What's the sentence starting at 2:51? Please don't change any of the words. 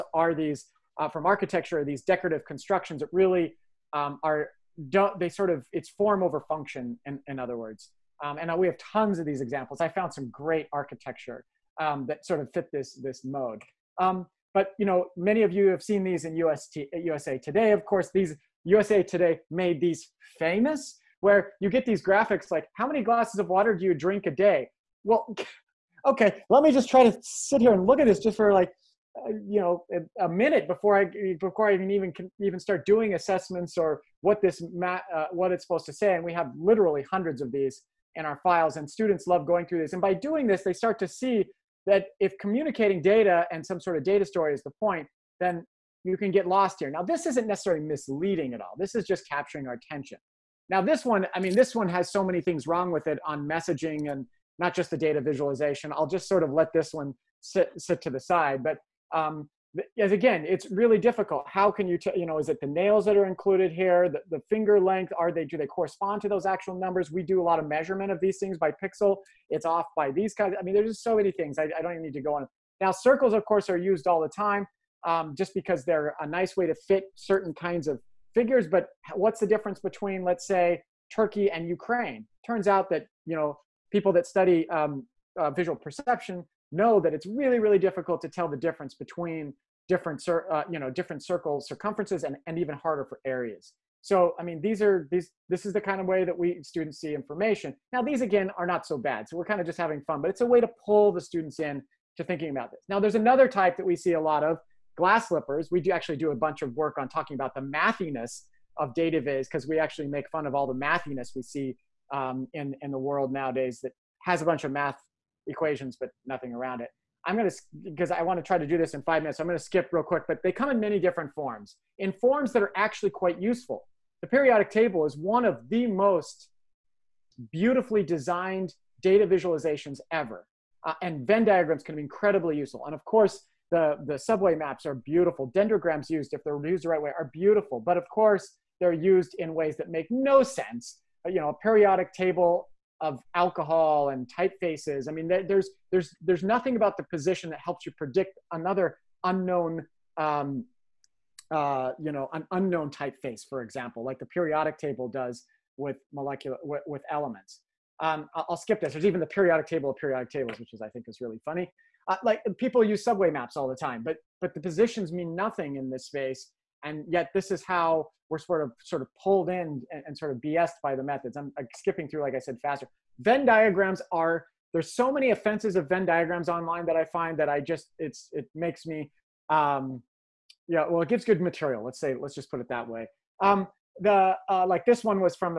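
I'm, I'm skipping through, like I said, faster.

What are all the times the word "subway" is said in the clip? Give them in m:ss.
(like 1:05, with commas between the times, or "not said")
2:14, 2:43.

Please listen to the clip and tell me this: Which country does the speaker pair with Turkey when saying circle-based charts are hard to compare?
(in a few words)
Ukraine.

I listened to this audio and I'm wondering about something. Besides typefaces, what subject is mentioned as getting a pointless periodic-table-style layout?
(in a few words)
alcohol.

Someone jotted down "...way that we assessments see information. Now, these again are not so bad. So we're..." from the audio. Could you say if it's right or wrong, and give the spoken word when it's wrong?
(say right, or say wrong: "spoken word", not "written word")
wrong: "students", not "assessments".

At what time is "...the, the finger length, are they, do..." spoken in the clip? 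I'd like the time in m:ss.
1:04.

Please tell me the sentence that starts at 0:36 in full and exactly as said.
And we have literally hundreds of these in our files, and students love going through this.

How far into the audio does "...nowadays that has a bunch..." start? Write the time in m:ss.
1:53.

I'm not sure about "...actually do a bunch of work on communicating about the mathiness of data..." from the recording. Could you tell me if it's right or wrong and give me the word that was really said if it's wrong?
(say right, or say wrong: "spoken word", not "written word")
wrong: "talking", not "communicating".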